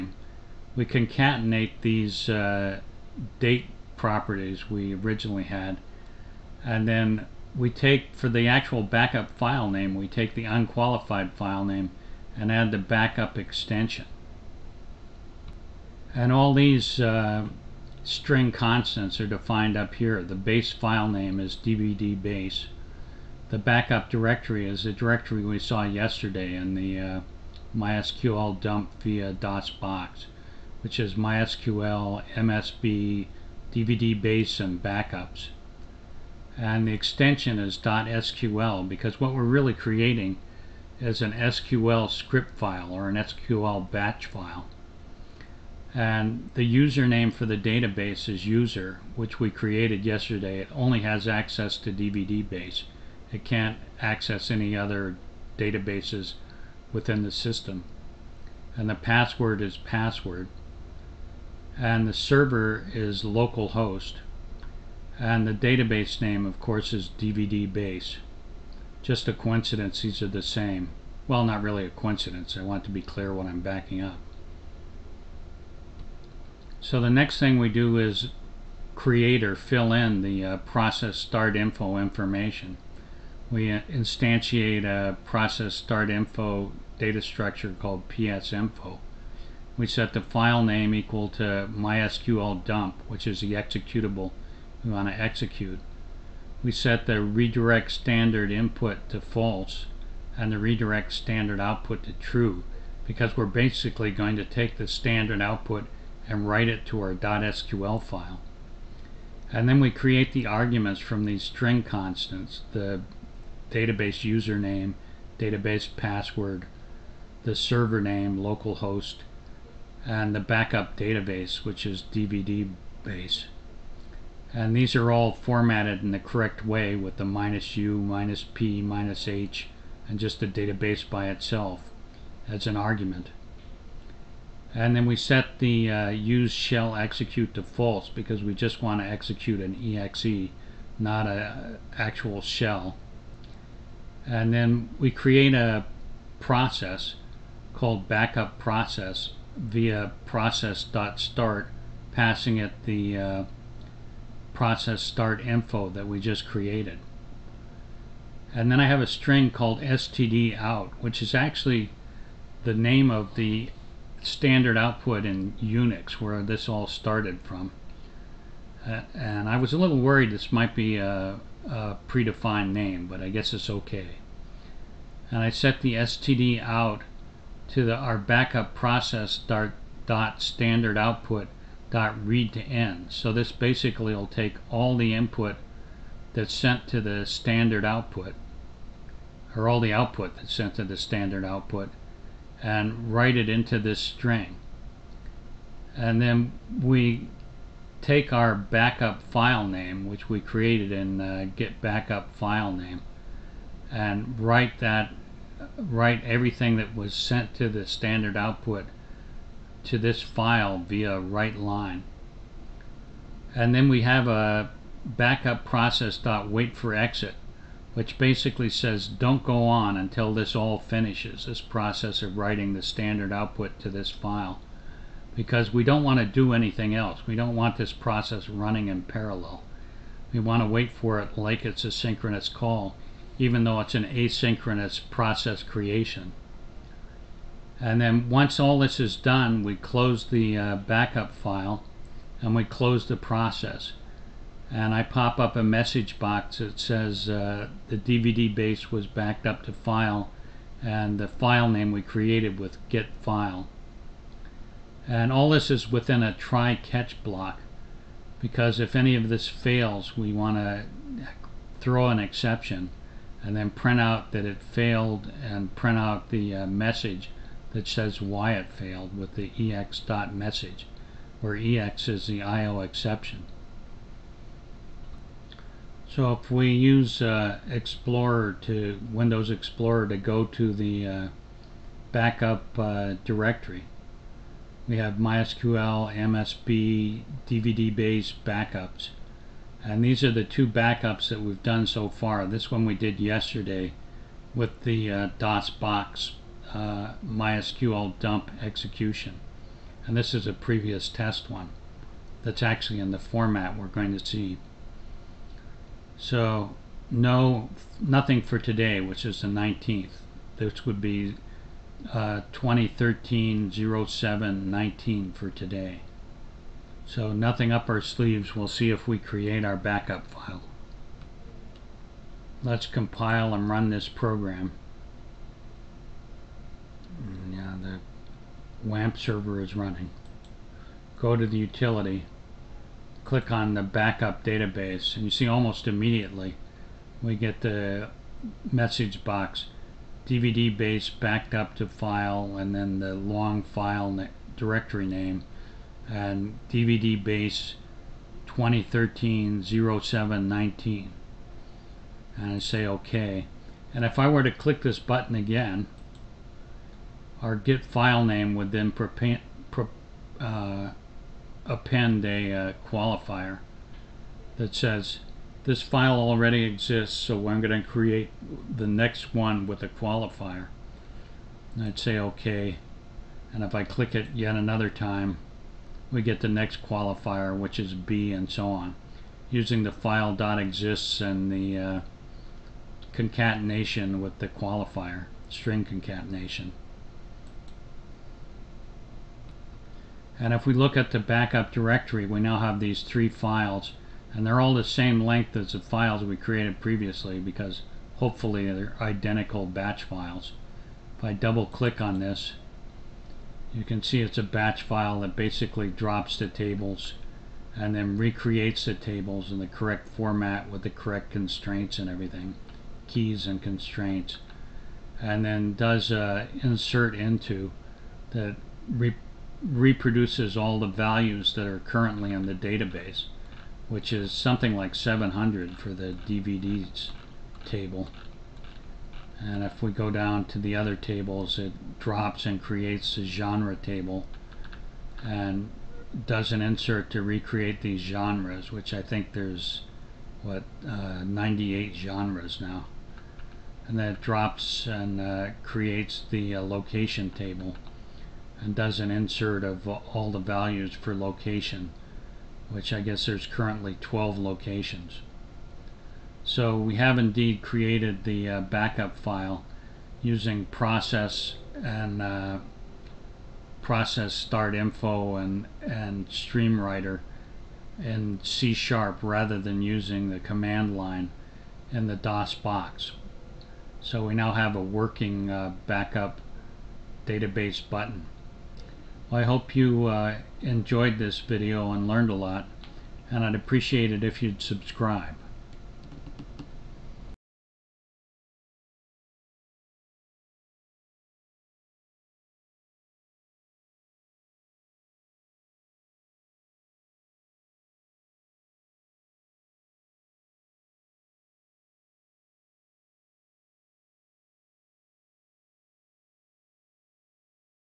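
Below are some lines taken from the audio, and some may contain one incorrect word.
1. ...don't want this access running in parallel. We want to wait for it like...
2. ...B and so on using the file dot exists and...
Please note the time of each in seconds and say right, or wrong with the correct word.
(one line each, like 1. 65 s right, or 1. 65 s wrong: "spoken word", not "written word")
1. 227 s wrong: "process", not "access"
2. 377 s right.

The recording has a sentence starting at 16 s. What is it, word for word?
And all these uh, string constants are defined up here.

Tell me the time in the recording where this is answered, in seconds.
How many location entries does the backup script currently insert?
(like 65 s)
454 s.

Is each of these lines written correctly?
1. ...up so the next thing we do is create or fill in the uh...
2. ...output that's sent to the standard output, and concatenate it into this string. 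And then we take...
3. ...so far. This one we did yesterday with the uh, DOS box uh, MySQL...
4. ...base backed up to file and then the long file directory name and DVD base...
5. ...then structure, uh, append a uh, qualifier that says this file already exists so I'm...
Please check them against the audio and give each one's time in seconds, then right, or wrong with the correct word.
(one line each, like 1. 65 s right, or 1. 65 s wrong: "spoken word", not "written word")
1. 74 s right
2. 189 s wrong: "write", not "concatenate"
3. 291 s right
4. 340 s right
5. 358 s wrong: "prepare", not "structure".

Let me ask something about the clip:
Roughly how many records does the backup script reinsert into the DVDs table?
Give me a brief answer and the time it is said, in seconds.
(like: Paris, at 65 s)
700, at 424 s.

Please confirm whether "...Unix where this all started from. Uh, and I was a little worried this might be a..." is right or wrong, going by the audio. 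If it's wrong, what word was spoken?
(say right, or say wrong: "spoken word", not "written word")
right.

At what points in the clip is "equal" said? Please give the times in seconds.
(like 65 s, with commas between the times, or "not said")
90 s.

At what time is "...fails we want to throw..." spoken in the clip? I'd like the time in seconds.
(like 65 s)
259 s.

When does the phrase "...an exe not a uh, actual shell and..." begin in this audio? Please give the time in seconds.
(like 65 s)
139 s.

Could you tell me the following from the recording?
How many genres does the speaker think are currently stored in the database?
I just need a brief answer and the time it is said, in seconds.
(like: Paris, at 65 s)
98, at 441 s.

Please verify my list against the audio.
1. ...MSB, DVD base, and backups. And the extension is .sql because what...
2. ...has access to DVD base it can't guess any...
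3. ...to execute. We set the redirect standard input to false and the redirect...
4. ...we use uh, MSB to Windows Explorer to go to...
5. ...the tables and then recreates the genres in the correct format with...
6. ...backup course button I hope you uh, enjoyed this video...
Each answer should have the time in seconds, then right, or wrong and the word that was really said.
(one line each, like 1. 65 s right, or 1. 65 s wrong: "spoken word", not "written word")
1. 32 s right
2. 51 s wrong: "access", not "guess"
3. 95 s right
4. 276 s wrong: "Explorer", not "MSB"
5. 406 s wrong: "tables", not "genres"
6. 475 s wrong: "database", not "course".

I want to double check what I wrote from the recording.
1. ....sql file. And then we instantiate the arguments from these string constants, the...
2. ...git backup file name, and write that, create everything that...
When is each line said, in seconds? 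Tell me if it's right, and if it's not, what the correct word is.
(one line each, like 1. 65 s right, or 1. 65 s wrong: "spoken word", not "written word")
1. 107 s wrong: "create", not "instantiate"
2. 201 s wrong: "write", not "create".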